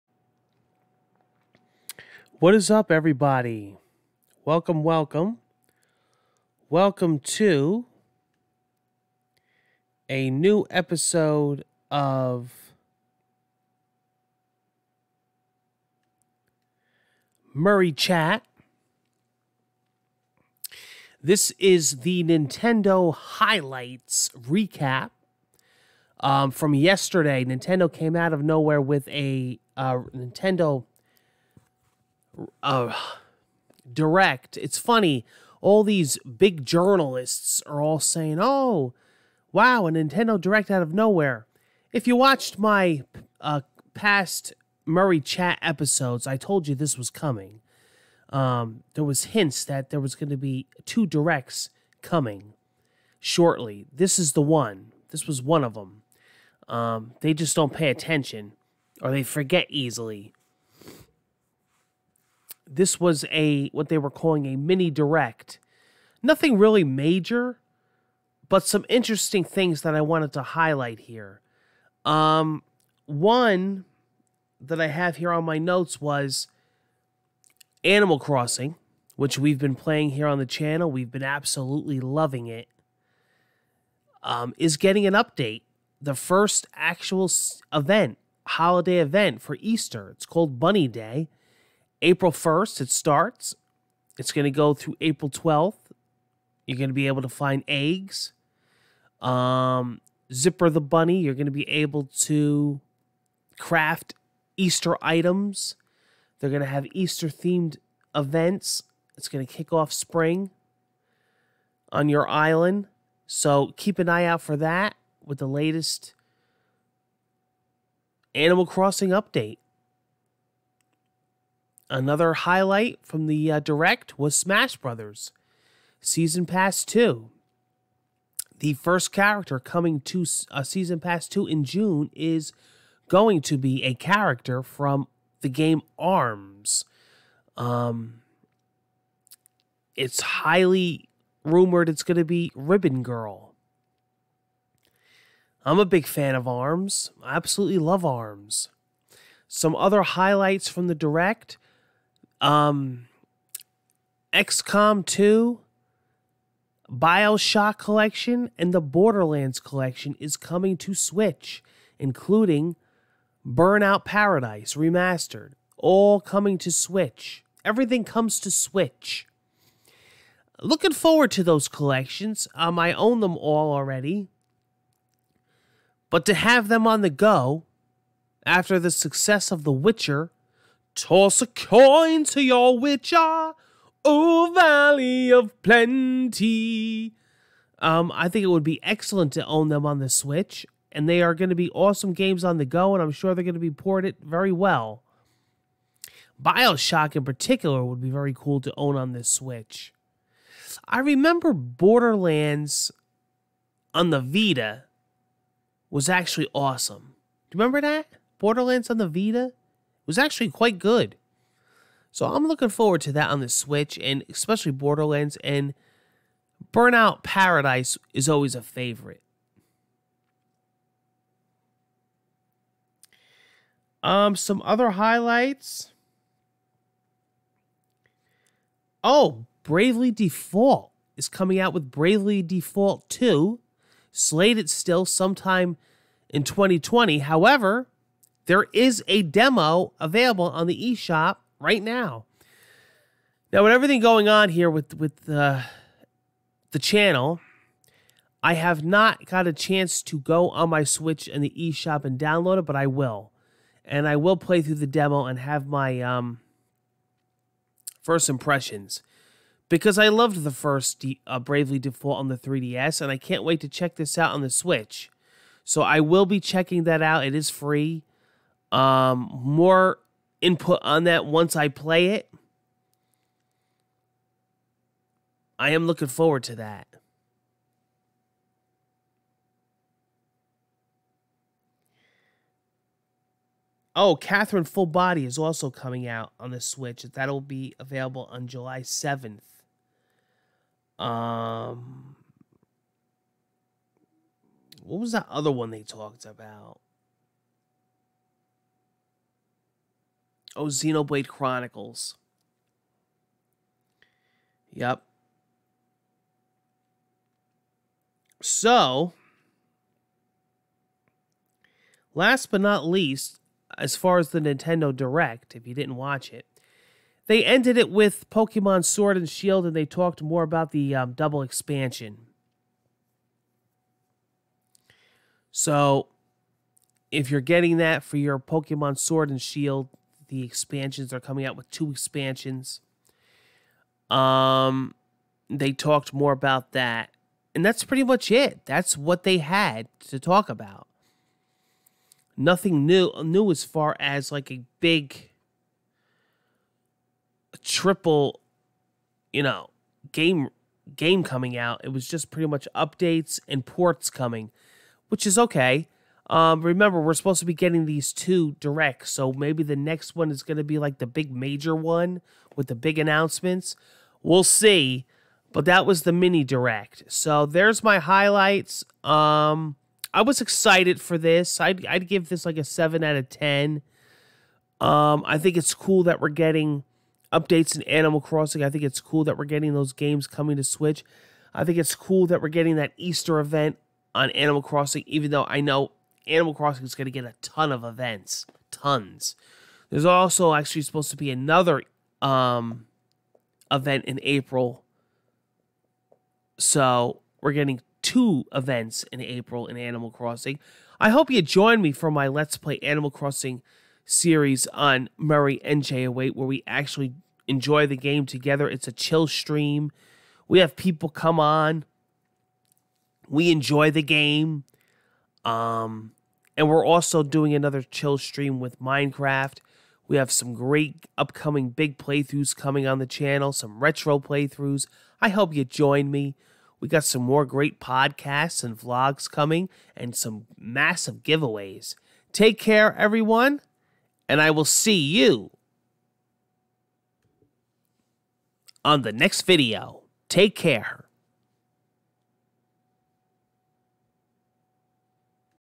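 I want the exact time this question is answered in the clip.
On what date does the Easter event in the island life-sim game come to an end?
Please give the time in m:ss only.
1:35.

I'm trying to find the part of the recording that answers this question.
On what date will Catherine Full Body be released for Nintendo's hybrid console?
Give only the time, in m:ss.
4:48.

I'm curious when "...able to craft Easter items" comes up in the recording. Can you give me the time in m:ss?
1:41.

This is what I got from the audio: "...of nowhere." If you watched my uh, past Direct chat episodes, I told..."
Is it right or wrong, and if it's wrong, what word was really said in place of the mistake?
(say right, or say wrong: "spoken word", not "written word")
wrong: "Murray", not "Direct".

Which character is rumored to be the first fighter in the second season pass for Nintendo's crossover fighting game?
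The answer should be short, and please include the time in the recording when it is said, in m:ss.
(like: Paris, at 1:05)
Ribbon Girl, at 2:22.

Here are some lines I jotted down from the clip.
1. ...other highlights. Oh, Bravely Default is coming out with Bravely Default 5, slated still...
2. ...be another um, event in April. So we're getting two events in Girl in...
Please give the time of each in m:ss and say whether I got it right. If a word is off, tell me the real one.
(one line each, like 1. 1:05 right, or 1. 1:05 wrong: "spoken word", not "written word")
1. 3:44 wrong: "2", not "5"
2. 6:31 wrong: "April", not "Girl".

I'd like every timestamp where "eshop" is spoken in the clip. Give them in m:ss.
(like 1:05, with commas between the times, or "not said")
4:00, 4:11.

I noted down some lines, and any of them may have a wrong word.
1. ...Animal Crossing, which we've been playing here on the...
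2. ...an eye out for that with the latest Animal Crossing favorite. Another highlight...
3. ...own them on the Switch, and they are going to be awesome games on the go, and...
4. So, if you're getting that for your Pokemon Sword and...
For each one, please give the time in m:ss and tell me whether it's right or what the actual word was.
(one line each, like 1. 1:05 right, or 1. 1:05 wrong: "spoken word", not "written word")
1. 1:17 right
2. 1:53 wrong: "update", not "favorite"
3. 3:09 right
4. 5:25 right.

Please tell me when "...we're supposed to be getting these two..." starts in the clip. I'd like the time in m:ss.
5:57.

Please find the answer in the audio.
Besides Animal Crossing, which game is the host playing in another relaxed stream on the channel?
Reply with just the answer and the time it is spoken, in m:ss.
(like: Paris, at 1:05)
Minecraft, at 6:58.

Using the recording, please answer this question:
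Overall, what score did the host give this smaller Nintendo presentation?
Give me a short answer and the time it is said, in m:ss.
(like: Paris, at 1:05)
7 out of 10, at 6:12.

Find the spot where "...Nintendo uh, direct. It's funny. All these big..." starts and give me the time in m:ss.
0:30.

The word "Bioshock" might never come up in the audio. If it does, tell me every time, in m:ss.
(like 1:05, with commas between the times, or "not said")
2:36, 3:16.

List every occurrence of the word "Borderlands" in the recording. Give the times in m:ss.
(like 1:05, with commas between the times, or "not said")
2:38, 3:21, 3:28, 3:34.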